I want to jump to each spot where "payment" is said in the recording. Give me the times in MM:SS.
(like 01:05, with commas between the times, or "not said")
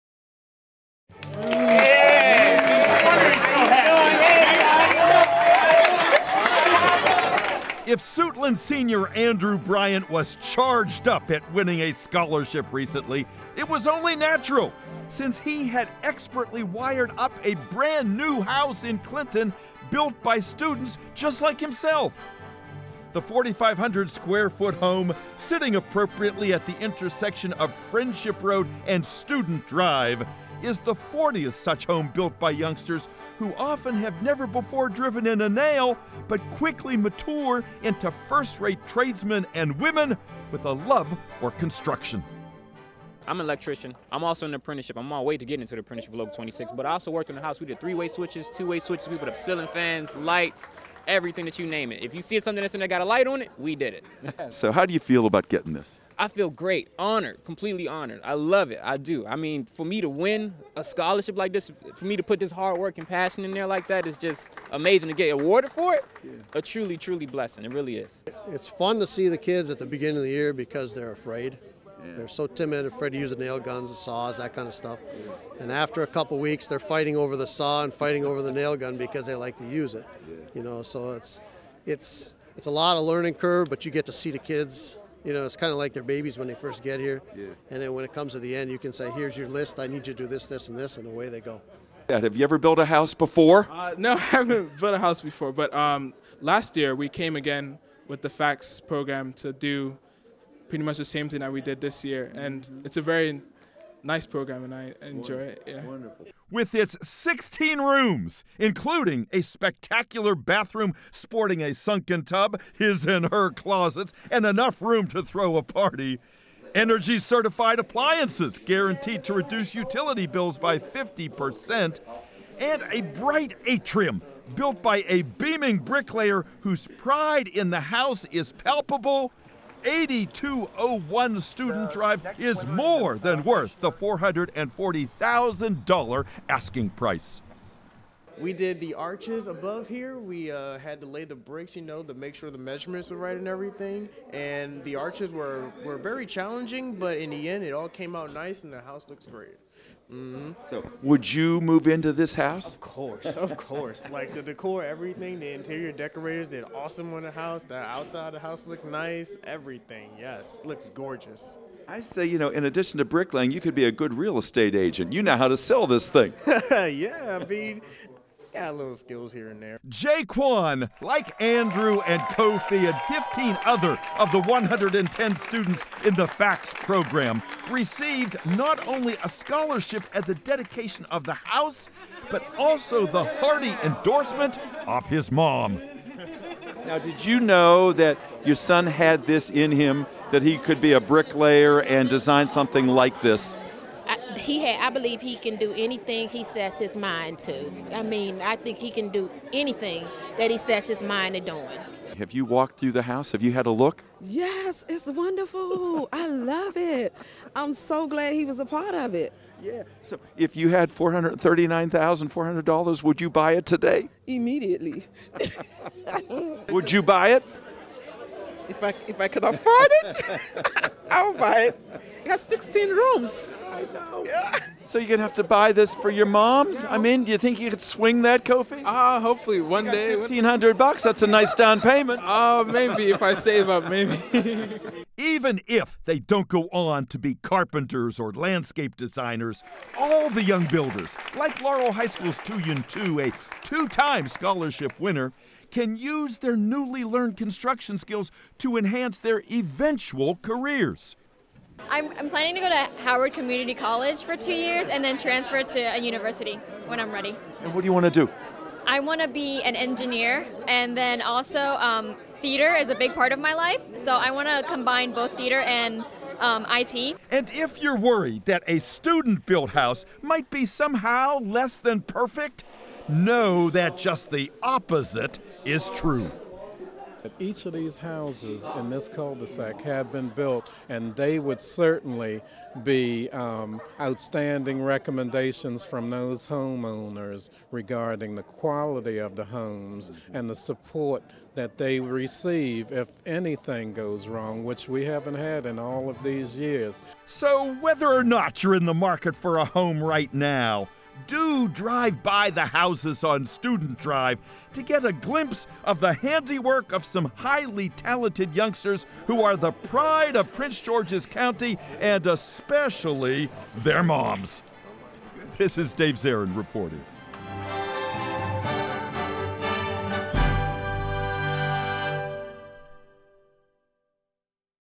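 03:51.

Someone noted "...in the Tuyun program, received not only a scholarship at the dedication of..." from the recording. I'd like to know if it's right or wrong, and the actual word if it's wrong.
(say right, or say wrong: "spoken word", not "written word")
wrong: "FACTS", not "Tuyun".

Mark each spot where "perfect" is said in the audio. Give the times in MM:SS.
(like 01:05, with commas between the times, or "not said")
04:32.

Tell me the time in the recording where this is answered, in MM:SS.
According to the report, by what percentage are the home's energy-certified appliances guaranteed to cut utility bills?
02:00.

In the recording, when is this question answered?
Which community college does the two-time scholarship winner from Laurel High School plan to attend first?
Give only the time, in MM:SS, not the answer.
04:13.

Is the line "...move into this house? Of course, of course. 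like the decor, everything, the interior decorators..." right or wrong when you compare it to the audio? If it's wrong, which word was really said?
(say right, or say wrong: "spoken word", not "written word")
right.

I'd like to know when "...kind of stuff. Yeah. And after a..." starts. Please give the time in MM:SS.
01:14.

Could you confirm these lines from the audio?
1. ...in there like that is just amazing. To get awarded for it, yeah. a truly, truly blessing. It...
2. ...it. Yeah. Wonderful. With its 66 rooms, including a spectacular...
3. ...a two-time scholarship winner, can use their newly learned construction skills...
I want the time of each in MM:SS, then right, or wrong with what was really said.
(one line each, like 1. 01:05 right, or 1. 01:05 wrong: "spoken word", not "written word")
1. 01:03 right
2. 01:45 wrong: "16", not "66"
3. 04:03 right.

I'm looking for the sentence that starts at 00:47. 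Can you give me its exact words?
We did three-way switches, two-way switches.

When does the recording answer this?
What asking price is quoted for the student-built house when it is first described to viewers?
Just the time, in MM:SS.
02:13.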